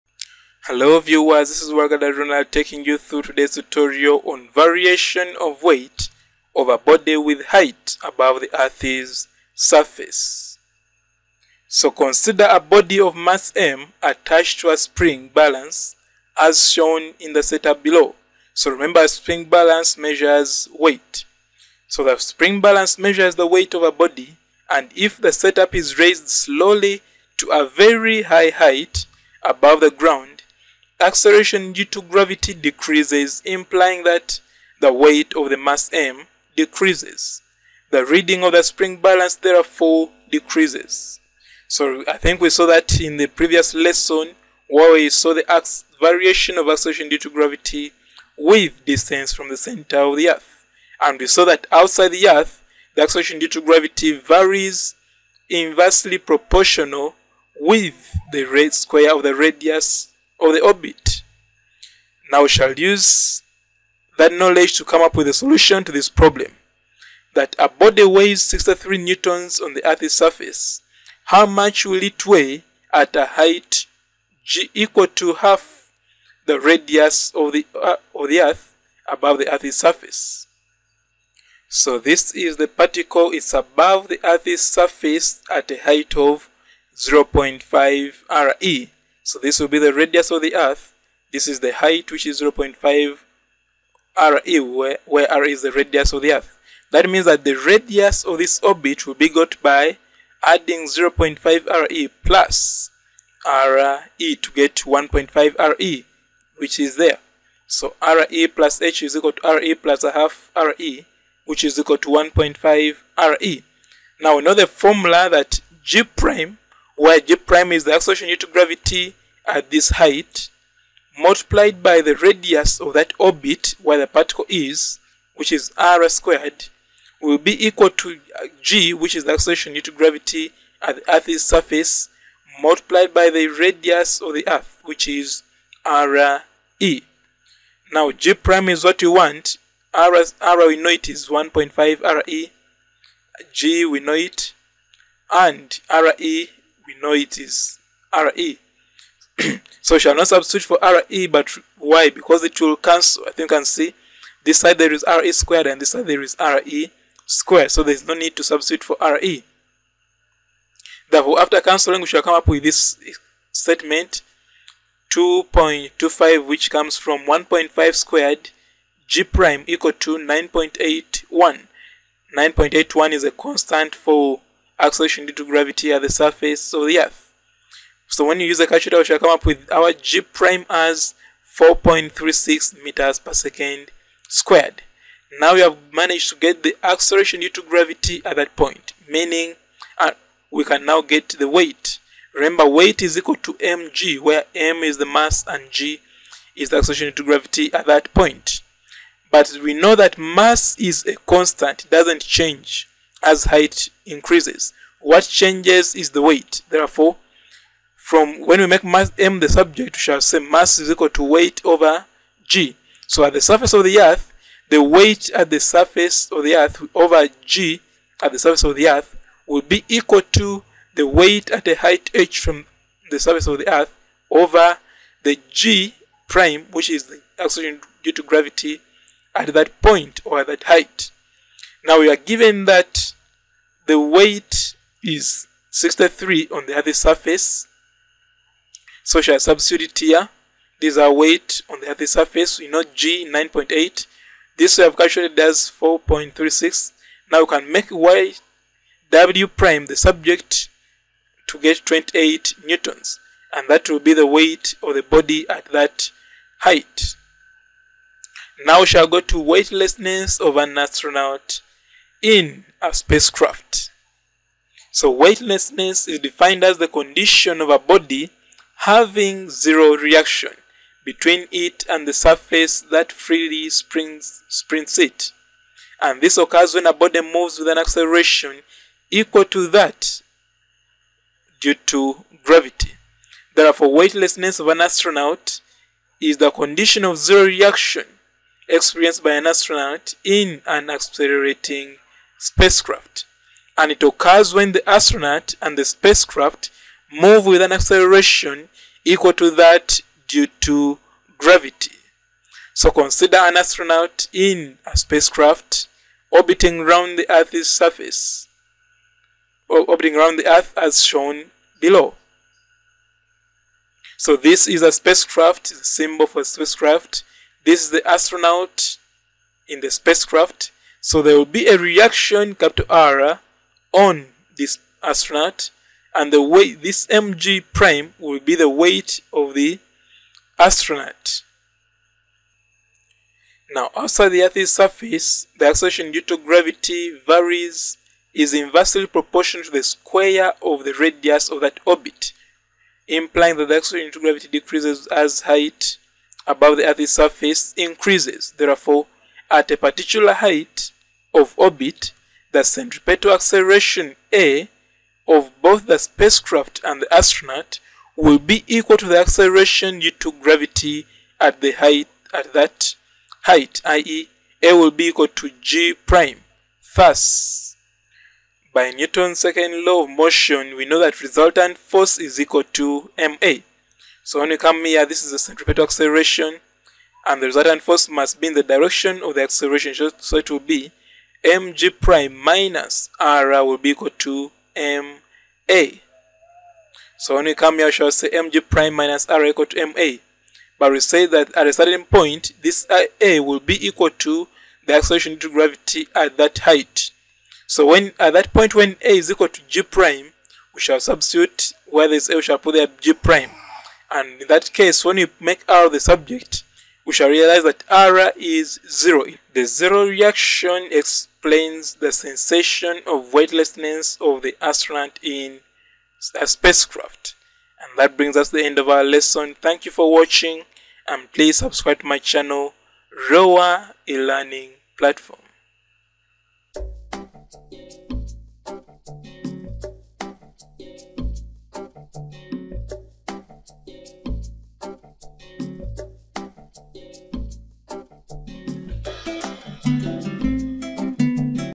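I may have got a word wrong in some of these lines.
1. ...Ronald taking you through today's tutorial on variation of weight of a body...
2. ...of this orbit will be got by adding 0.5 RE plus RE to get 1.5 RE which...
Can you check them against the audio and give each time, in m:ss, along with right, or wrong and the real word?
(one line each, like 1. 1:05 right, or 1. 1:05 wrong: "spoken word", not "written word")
1. 0:02 right
2. 1:38 right.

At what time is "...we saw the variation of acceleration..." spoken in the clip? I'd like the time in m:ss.
0:44.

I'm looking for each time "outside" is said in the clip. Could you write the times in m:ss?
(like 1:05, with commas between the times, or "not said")
0:51, 5:33.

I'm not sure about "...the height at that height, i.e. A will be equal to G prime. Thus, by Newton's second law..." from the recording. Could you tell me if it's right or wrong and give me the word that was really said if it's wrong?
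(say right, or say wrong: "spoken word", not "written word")
right.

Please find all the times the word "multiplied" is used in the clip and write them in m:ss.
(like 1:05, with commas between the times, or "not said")
2:01, 2:12.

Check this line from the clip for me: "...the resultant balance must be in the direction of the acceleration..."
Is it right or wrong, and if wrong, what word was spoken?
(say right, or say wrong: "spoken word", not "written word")
wrong: "force", not "balance".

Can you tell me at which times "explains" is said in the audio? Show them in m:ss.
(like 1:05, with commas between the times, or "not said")
6:50.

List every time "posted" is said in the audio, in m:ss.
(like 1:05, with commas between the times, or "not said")
not said.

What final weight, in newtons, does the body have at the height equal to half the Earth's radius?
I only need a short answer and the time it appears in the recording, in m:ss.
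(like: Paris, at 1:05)
28 newtons, at 4:11.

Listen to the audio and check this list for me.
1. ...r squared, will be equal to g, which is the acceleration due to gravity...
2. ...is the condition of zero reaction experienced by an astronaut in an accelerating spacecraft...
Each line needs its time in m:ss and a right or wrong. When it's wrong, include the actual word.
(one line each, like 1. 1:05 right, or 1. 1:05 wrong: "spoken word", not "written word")
1. 2:05 right
2. 4:46 right.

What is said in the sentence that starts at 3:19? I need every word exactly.
But we know that mass is a constant, it doesn't change as height increases.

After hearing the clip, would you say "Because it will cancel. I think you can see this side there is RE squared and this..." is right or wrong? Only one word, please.
right.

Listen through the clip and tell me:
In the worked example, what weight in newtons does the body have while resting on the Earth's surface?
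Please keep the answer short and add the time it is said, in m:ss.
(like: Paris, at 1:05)
63 newtons, at 1:08.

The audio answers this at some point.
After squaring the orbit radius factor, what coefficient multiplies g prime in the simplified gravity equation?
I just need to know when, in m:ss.
2:45.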